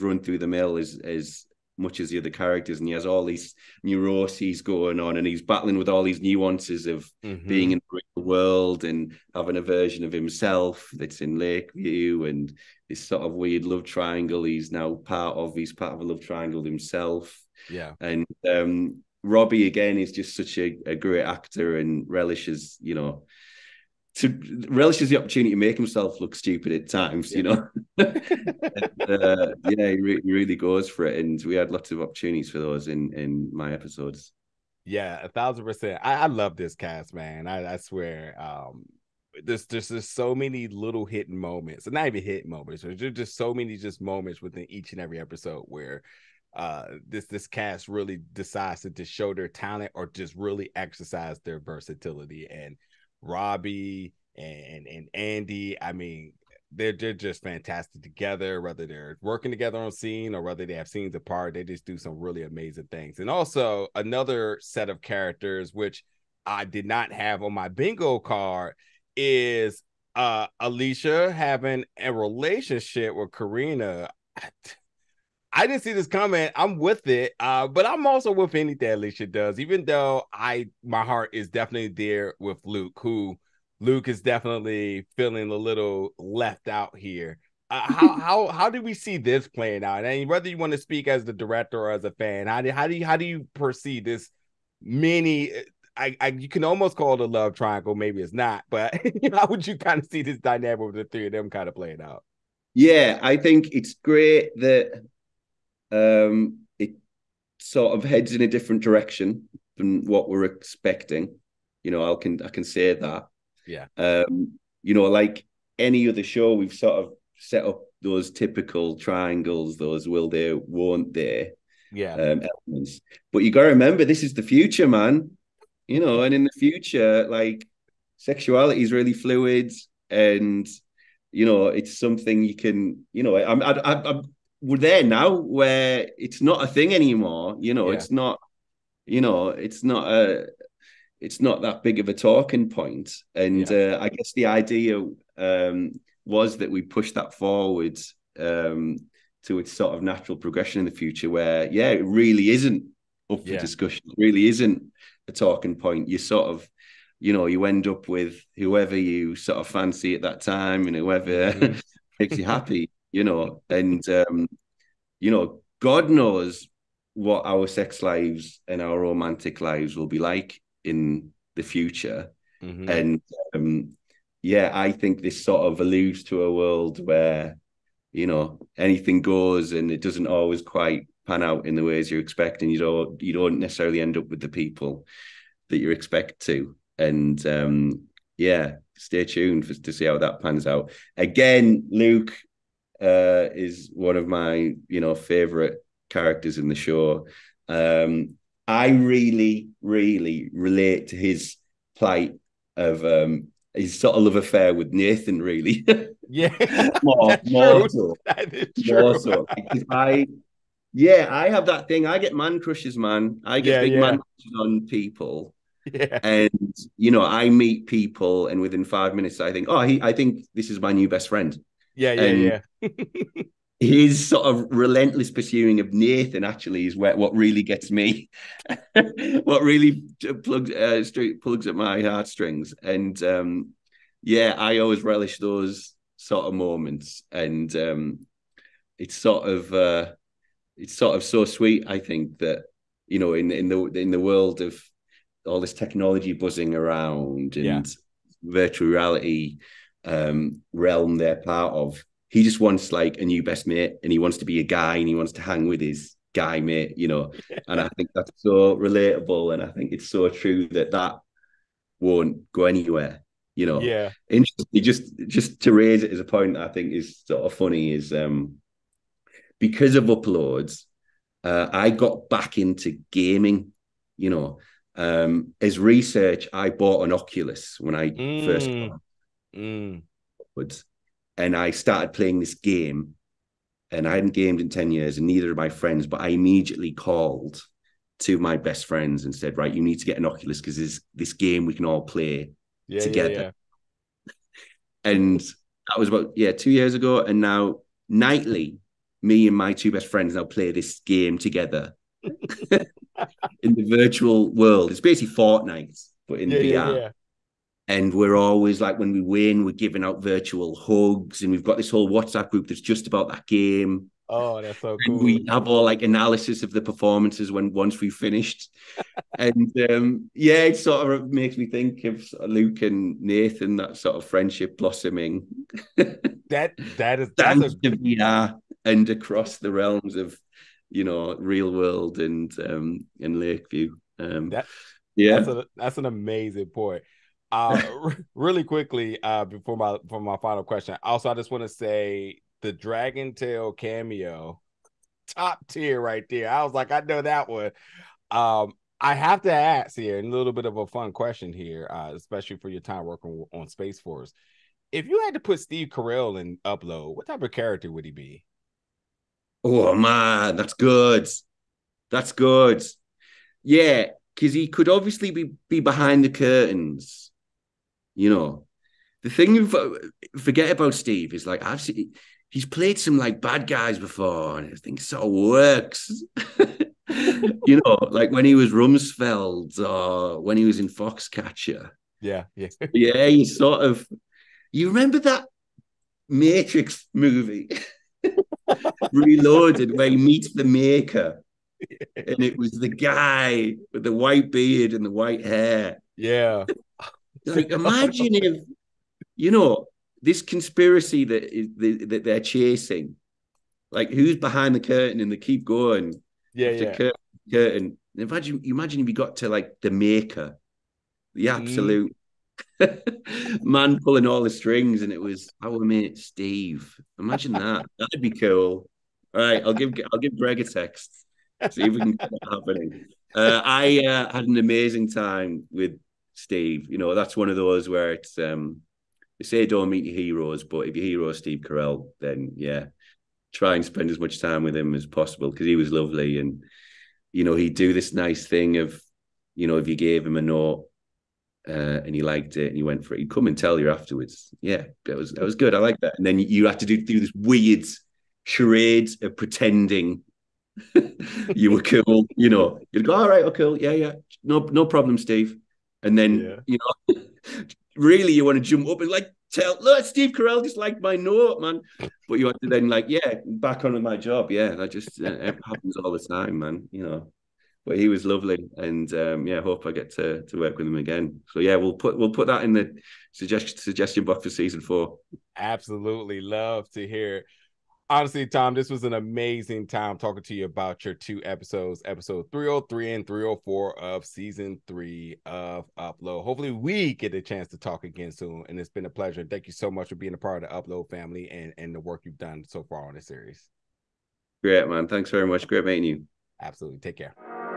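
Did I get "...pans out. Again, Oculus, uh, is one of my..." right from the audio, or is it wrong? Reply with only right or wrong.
wrong.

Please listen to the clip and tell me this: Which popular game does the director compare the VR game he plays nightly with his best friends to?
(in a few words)
Fortnite.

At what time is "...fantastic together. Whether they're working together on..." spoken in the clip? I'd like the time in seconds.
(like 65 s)
57 s.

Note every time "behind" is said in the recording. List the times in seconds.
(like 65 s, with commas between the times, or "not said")
365 s, 404 s.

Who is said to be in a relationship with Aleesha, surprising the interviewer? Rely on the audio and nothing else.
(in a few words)
Karina.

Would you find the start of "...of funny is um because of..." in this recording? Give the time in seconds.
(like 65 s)
267 s.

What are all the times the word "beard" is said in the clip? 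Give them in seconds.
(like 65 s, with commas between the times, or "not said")
394 s.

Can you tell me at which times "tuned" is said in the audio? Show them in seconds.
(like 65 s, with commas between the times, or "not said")
189 s.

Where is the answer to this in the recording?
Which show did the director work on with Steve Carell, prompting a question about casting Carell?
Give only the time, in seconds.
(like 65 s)
353 s.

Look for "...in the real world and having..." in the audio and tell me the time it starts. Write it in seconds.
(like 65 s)
7 s.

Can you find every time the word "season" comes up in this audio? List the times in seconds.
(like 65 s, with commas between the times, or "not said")
474 s, 484 s.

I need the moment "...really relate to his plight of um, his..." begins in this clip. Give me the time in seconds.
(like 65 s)
199 s.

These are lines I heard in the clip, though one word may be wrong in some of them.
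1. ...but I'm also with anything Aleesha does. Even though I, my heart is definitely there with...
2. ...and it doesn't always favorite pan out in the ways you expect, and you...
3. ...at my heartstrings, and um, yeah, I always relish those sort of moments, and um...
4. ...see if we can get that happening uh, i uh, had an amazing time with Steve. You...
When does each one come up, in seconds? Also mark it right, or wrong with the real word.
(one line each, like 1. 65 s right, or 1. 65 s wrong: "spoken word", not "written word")
1. 77 s right
2. 179 s wrong: "quite", not "favorite"
3. 231 s right
4. 421 s right.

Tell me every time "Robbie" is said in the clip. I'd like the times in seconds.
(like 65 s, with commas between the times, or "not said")
19 s, 53 s.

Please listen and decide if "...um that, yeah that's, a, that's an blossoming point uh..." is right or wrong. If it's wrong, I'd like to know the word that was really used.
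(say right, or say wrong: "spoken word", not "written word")
wrong: "amazing", not "blossoming".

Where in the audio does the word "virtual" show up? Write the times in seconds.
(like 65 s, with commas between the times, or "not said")
248 s, 303 s, 310 s.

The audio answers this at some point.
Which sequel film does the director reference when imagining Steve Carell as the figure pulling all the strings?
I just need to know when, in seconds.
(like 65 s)
389 s.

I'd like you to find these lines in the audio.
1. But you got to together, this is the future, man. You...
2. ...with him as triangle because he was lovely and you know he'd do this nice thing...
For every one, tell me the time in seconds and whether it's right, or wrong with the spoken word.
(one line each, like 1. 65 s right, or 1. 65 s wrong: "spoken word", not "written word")
1. 123 s wrong: "remember", not "together"
2. 434 s wrong: "possible", not "triangle".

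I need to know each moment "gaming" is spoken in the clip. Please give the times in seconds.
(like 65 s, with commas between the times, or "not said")
273 s.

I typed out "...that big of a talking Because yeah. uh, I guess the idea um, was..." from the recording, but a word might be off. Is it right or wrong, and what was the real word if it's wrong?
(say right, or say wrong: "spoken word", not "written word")
wrong: "And", not "Because".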